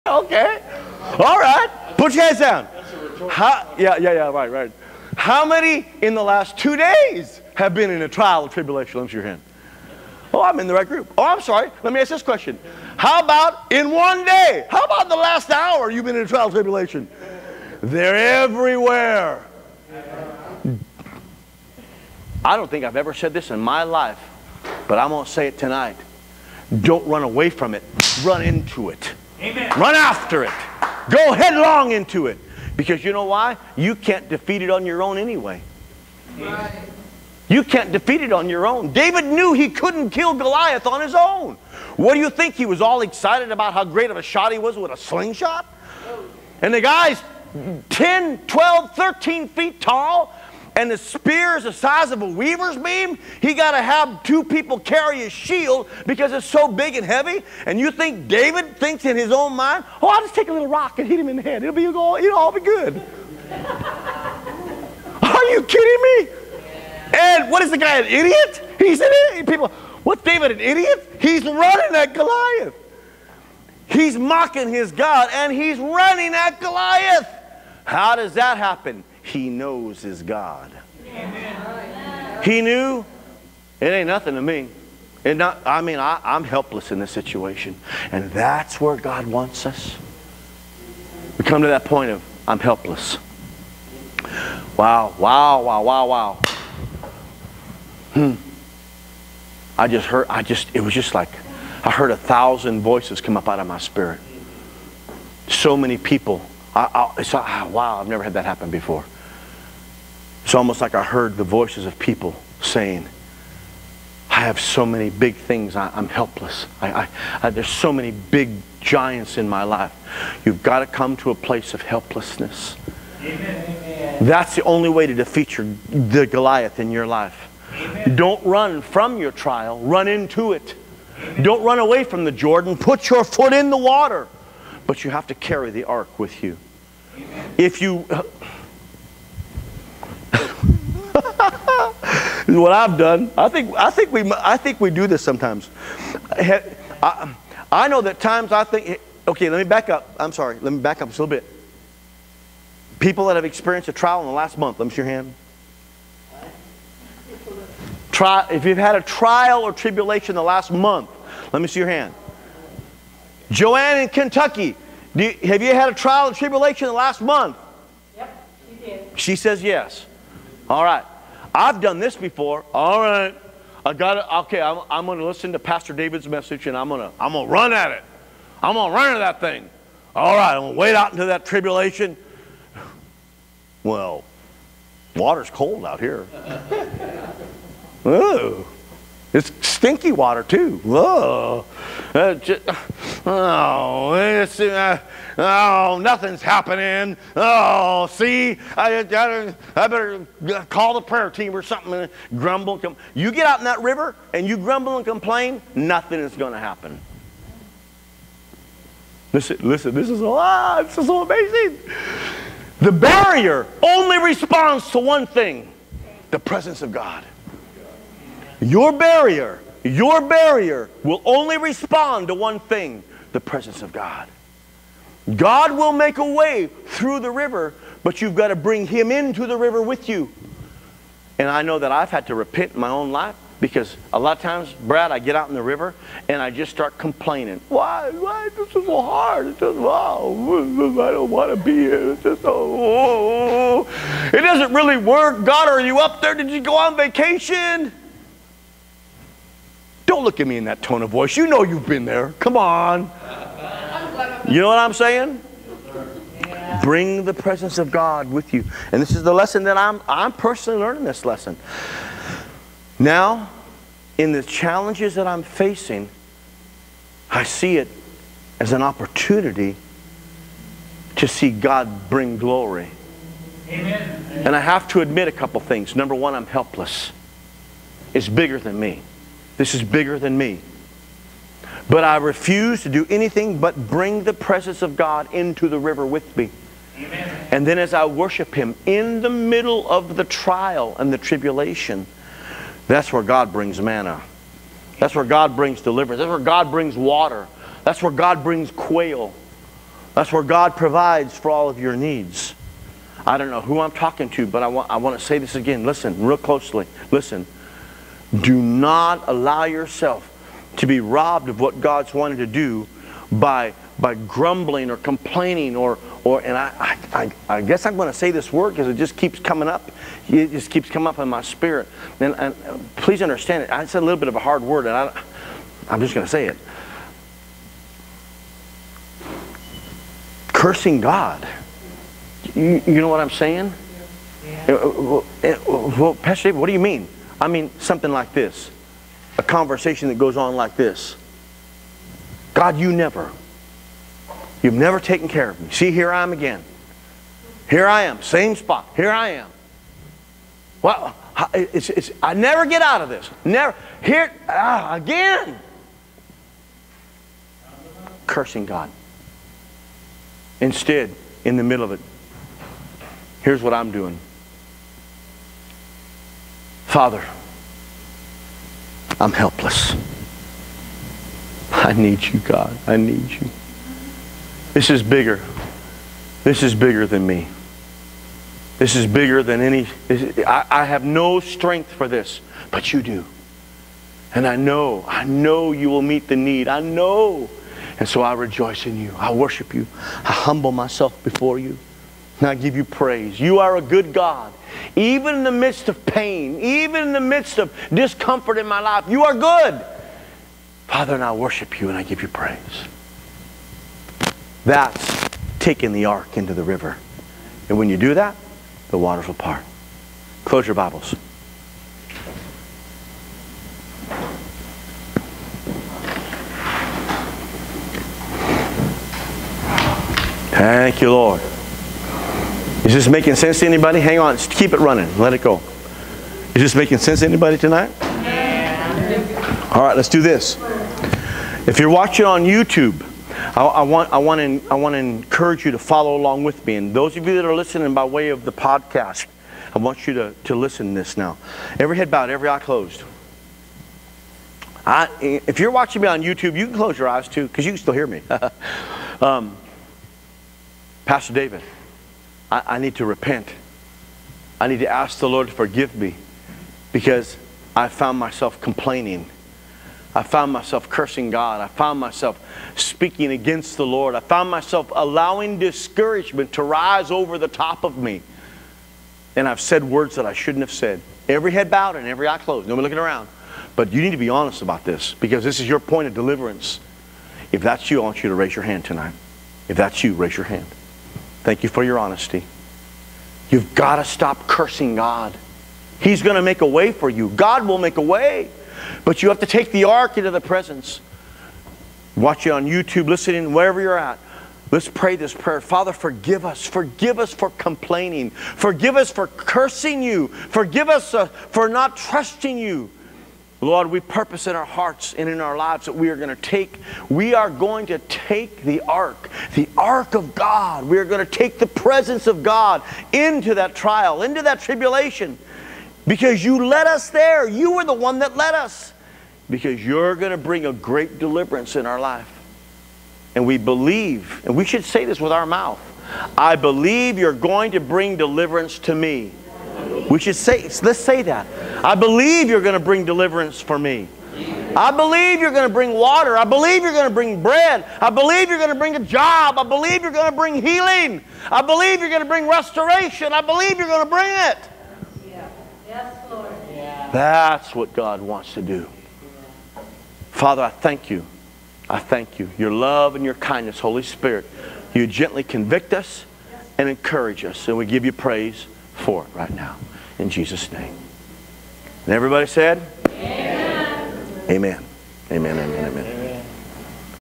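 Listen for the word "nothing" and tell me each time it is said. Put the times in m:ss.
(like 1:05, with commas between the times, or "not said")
1:24, 3:16, 3:25.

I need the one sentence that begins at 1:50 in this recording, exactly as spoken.
It's almost like I heard the voices of people saying, I have so many big things.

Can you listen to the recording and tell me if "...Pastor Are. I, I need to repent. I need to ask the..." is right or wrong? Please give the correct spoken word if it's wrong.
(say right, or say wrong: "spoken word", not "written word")
wrong: "David", not "Are".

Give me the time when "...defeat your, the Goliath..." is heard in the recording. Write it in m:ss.
2:05.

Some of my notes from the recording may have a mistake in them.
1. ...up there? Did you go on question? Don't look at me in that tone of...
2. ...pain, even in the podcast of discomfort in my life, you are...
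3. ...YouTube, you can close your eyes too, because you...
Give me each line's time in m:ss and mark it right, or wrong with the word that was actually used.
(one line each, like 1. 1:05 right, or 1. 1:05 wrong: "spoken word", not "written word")
1. 4:05 wrong: "vacation", not "question"
2. 6:36 wrong: "midst", not "podcast"
3. 7:26 right.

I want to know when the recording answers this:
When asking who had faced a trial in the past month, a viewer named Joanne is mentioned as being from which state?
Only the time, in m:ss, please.
2:44.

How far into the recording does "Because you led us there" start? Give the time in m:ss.
8:36.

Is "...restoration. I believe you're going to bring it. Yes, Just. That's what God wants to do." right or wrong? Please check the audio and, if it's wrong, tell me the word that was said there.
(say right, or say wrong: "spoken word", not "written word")
wrong: "Lord", not "Just".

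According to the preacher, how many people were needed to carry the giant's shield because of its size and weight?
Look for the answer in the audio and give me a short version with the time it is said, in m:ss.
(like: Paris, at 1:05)
2, at 0:54.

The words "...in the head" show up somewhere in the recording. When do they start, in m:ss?
1:01.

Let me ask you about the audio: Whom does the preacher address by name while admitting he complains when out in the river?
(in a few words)
Brad.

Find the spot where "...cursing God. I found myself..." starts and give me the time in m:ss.
7:40.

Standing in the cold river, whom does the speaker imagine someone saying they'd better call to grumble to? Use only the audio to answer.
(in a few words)
the prayer team.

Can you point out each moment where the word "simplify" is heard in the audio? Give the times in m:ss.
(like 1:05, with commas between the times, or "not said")
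not said.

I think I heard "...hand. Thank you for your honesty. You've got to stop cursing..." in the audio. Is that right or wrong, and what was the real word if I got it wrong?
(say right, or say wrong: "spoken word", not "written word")
right.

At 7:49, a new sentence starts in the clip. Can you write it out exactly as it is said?
And I've said words that I shouldn't have said.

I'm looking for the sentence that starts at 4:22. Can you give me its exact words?
Now, in the challenges that I'm facing, I see it as an opportunity to see God bring glory.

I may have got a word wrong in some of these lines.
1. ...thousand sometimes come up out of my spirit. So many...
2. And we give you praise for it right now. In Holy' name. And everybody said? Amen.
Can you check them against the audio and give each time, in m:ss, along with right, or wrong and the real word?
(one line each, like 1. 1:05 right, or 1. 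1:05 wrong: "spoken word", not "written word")
1. 1:42 wrong: "voices", not "sometimes"
2. 9:17 wrong: "Jesus", not "Holy".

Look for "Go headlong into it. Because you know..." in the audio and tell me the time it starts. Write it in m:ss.
0:31.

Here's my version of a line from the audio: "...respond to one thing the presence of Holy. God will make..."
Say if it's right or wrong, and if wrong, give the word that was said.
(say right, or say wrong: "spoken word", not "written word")
wrong: "God", not "Holy".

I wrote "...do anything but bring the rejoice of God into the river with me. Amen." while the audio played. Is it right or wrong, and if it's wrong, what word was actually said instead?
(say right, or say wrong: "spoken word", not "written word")
wrong: "presence", not "rejoice".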